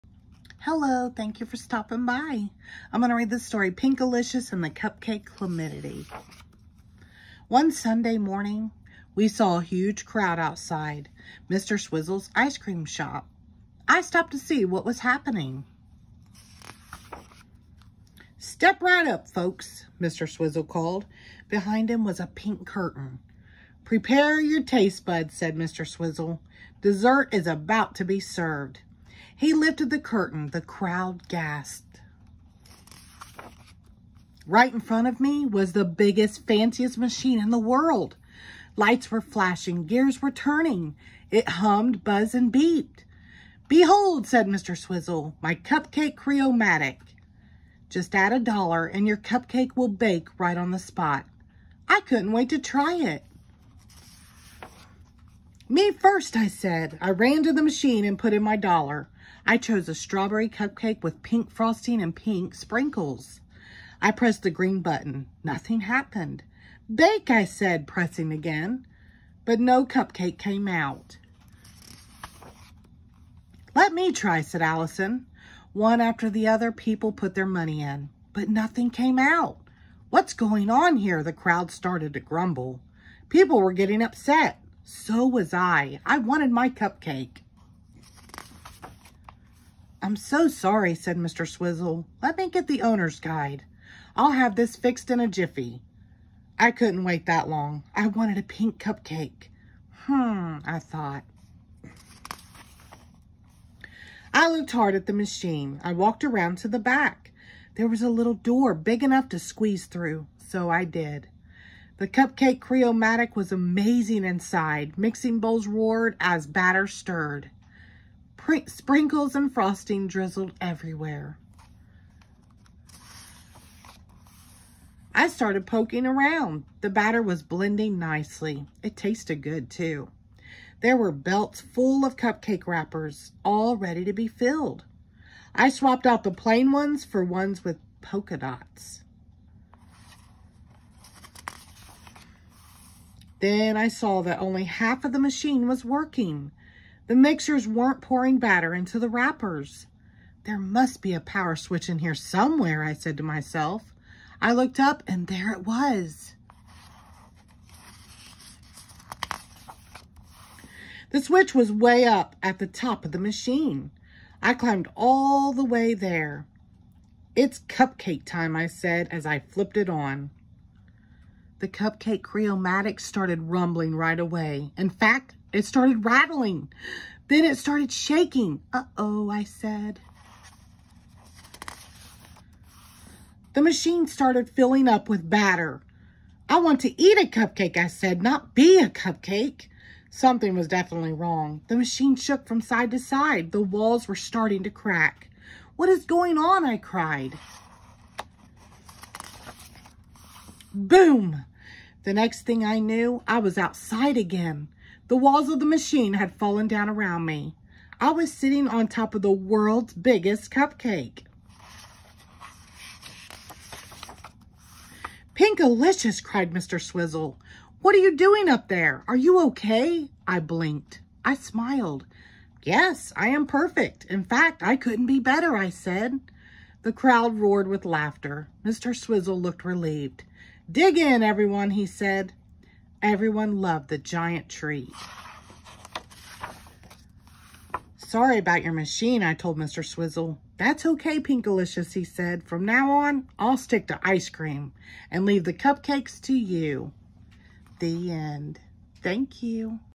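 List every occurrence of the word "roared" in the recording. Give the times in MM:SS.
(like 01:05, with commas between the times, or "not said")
01:55, 03:47.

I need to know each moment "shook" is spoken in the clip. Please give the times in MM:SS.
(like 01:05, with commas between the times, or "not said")
03:12.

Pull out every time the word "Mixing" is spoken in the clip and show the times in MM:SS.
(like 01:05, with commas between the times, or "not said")
01:54.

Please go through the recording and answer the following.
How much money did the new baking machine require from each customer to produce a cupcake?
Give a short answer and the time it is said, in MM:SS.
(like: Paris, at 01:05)
a dollar, at 00:48.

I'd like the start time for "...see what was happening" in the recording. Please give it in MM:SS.
00:14.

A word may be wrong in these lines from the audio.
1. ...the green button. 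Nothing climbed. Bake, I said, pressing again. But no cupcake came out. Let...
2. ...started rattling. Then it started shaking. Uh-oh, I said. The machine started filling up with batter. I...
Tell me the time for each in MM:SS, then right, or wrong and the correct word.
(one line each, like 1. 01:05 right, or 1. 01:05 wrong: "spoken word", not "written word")
1. 01:04 wrong: "happened", not "climbed"
2. 02:55 right.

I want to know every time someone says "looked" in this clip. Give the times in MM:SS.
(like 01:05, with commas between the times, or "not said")
01:44, 02:34, 03:49.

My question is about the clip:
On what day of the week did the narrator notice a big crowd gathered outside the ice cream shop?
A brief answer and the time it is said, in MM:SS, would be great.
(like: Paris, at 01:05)
Sunday, at 00:07.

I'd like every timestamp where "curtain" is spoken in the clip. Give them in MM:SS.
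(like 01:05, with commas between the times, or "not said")
00:22, 00:29.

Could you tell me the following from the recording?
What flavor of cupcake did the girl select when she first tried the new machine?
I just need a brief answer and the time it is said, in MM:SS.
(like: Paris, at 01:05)
strawberry, at 00:59.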